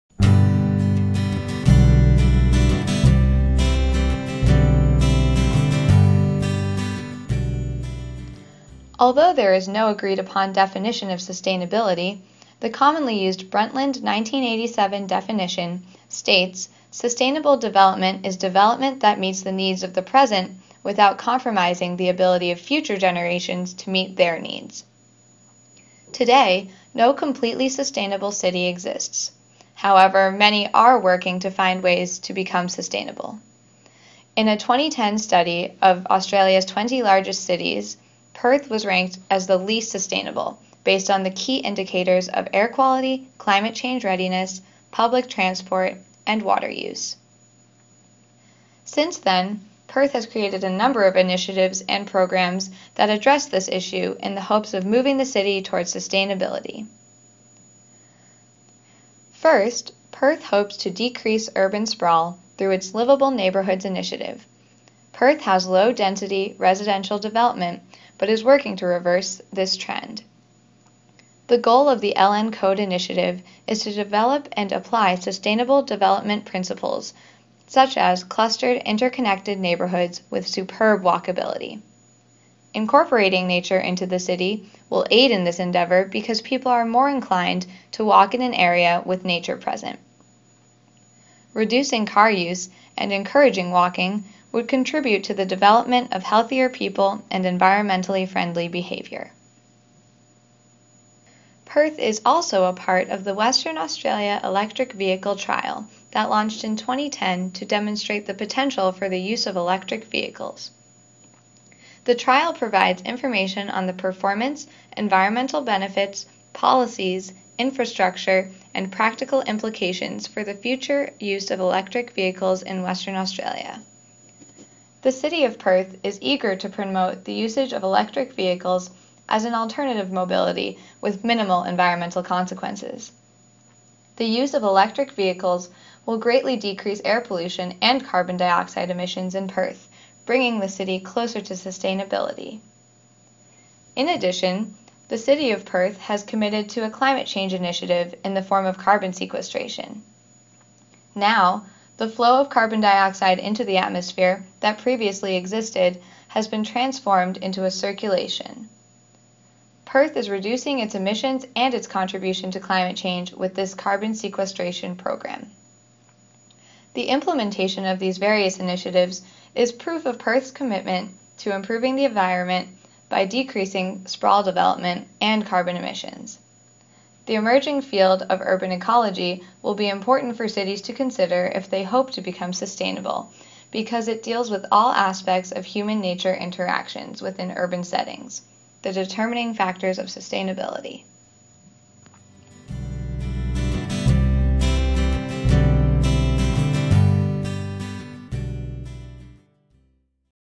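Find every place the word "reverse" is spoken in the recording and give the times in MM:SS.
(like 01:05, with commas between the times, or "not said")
01:08.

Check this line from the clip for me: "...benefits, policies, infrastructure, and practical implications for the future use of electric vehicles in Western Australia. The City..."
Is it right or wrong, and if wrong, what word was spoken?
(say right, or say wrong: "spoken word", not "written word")
right.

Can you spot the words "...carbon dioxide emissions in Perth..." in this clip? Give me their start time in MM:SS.
02:18.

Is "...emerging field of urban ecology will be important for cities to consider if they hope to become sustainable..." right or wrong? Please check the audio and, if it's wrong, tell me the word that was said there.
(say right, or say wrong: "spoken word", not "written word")
right.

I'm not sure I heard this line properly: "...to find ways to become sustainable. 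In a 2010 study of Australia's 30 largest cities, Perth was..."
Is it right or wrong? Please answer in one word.
wrong.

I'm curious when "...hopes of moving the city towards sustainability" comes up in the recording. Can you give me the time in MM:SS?
00:54.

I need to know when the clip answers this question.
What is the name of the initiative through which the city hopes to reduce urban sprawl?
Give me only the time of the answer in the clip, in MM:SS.
01:02.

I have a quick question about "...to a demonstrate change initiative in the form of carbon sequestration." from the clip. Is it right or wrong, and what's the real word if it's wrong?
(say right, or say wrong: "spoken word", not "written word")
wrong: "climate", not "demonstrate".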